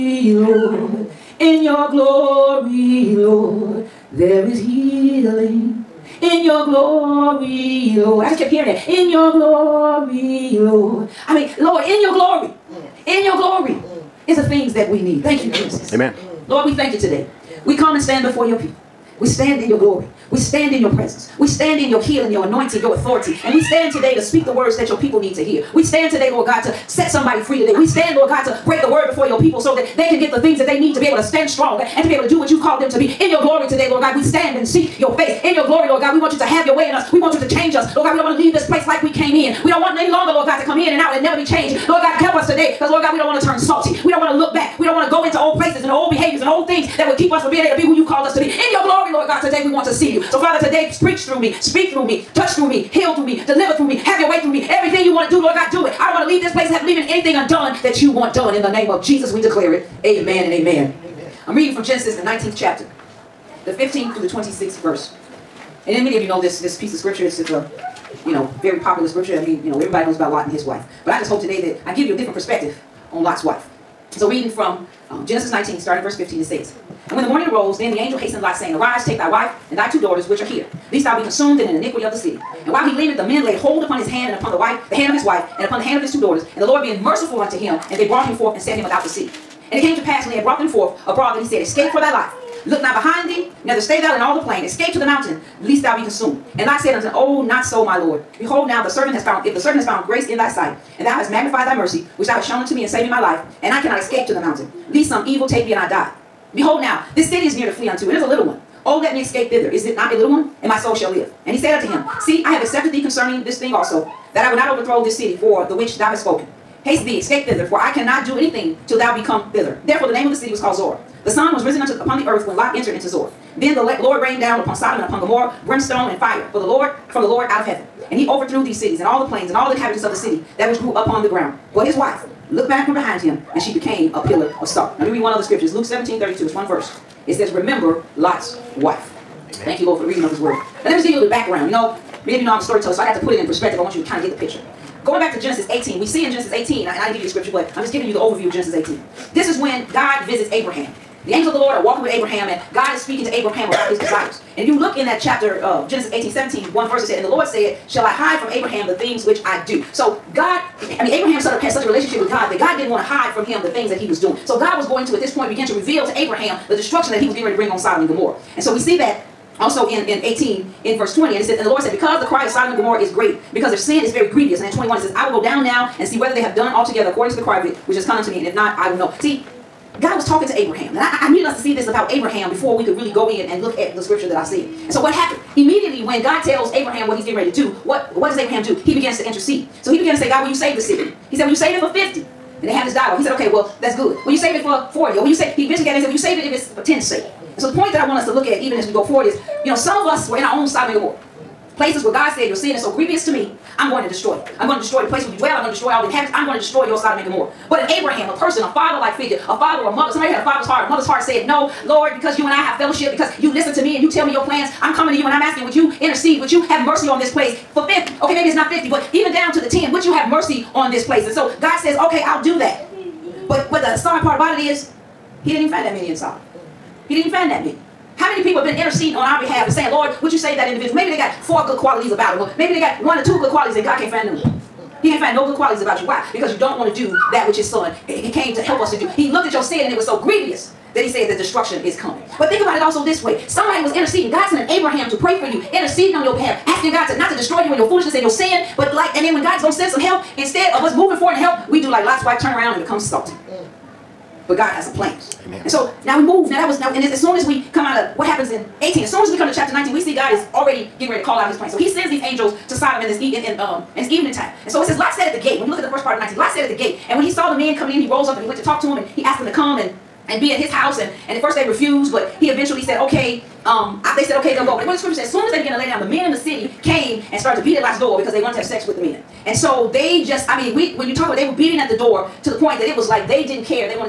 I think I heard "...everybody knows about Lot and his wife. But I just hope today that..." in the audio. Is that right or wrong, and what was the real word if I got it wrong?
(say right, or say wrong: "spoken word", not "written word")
right.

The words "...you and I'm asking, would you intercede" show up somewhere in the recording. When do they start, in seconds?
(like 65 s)
215 s.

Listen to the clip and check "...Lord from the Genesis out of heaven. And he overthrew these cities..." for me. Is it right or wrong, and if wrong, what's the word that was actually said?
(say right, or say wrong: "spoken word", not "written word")
wrong: "Lord", not "Genesis".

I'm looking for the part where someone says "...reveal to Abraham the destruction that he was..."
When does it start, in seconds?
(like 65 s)
165 s.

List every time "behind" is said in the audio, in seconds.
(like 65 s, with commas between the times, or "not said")
92 s, 132 s.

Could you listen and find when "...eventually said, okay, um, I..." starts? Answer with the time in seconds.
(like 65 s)
272 s.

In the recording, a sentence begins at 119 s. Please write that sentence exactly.
Therefore the name of the city was called Zoar.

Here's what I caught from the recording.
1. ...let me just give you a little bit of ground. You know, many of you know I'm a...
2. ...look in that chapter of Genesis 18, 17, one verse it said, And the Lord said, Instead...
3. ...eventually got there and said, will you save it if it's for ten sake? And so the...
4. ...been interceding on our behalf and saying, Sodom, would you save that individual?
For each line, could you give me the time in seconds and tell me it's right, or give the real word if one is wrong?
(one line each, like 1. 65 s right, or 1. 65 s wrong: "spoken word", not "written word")
1. 140 s wrong: "background", not "ground"
2. 154 s wrong: "Shall", not "Instead"
3. 195 s right
4. 228 s wrong: "Lord", not "Sodom".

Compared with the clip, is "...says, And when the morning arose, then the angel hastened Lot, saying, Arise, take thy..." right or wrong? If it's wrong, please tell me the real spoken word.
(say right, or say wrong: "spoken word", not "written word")
right.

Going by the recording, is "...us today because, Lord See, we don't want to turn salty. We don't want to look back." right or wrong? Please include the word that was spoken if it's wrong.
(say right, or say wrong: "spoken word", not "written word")
wrong: "God", not "See".